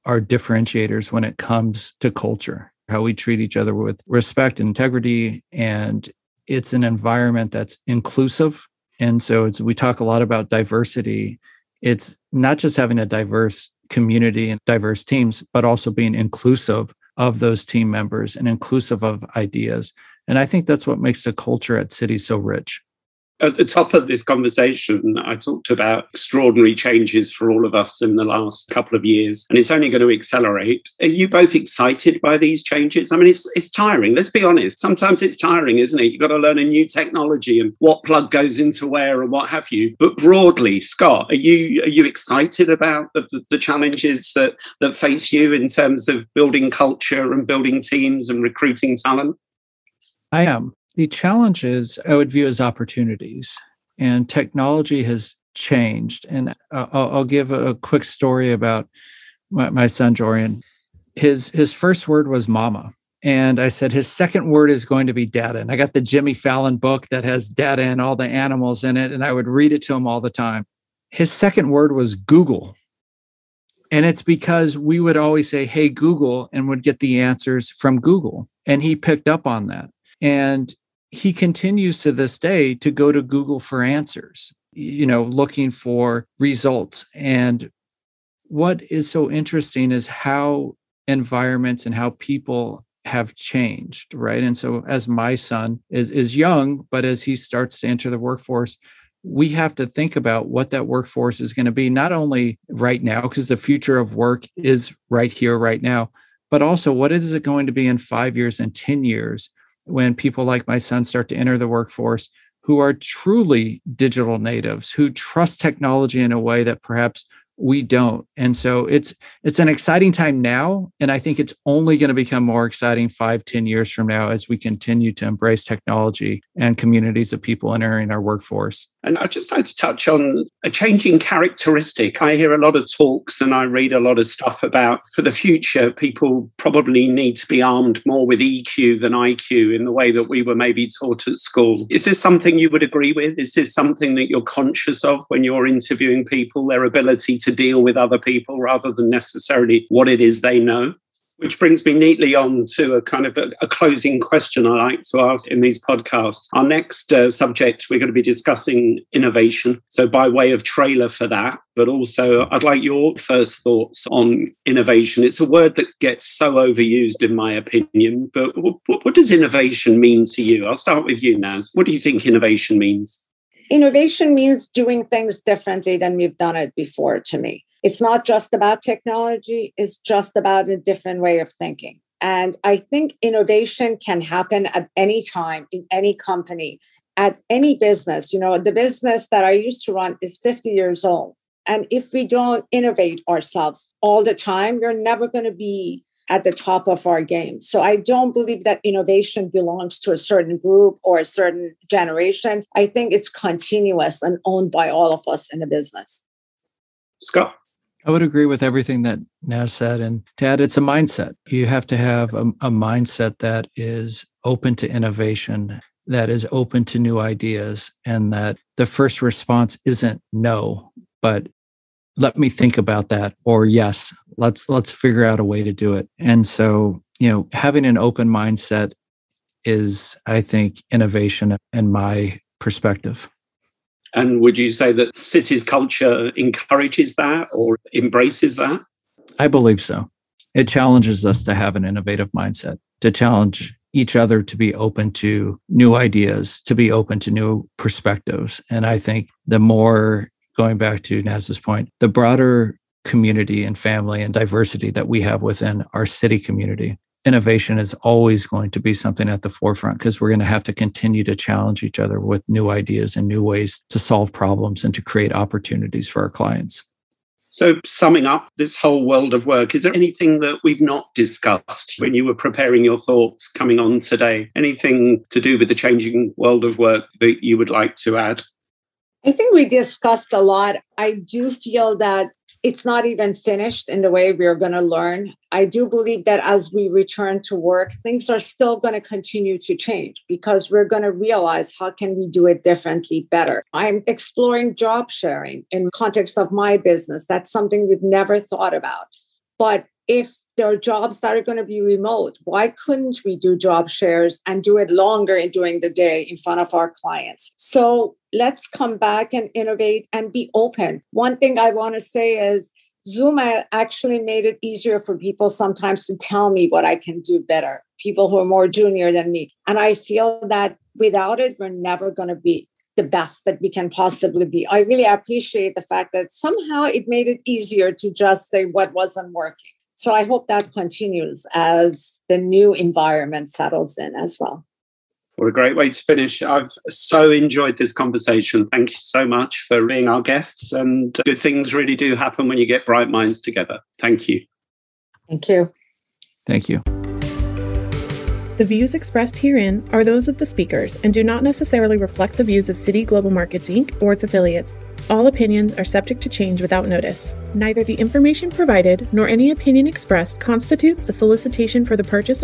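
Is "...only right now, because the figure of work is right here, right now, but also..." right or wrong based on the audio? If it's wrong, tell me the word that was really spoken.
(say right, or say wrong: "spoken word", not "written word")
wrong: "future", not "figure".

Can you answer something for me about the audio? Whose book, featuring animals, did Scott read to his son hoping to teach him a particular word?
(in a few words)
Jimmy Fallon.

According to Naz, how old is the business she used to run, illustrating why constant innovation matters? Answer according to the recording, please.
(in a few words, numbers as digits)
50 years.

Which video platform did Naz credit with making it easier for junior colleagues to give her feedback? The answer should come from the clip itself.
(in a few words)
Zoom.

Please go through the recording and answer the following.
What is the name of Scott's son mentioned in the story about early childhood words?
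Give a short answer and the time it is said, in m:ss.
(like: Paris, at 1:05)
Jorian, at 1:00.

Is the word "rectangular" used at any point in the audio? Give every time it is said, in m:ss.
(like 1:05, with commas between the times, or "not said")
not said.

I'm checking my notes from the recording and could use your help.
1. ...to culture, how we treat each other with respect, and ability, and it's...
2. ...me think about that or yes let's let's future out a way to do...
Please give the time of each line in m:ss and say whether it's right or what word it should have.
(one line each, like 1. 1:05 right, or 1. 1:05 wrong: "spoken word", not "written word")
1. 0:02 wrong: "integrity", not "ability"
2. 3:42 wrong: "figure", not "future".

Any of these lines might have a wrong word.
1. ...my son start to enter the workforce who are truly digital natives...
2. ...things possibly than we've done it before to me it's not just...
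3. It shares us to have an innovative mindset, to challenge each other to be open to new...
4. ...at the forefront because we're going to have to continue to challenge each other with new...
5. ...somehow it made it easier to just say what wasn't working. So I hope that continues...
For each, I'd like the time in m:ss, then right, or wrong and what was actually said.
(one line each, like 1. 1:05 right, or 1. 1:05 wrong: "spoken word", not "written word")
1. 1:50 right
2. 2:55 wrong: "differently", not "possibly"
3. 4:00 wrong: "challenges", not "shares"
4. 4:19 right
5. 5:26 right.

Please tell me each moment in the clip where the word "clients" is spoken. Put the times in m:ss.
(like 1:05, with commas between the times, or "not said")
4:26, 5:07.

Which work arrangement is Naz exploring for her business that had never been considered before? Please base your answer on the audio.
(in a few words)
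Job sharing.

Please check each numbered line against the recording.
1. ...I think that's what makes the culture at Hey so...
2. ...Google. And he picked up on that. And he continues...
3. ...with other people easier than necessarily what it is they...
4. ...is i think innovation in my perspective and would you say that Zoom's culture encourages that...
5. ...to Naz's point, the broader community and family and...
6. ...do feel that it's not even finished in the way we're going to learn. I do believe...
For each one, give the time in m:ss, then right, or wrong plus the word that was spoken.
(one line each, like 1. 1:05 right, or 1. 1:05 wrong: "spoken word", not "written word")
1. 0:20 wrong: "Citi", not "Hey"
2. 1:17 right
3. 2:27 wrong: "rather", not "easier"
4. 3:49 wrong: "Citi", not "Zoom"
5. 4:11 right
6. 4:41 right.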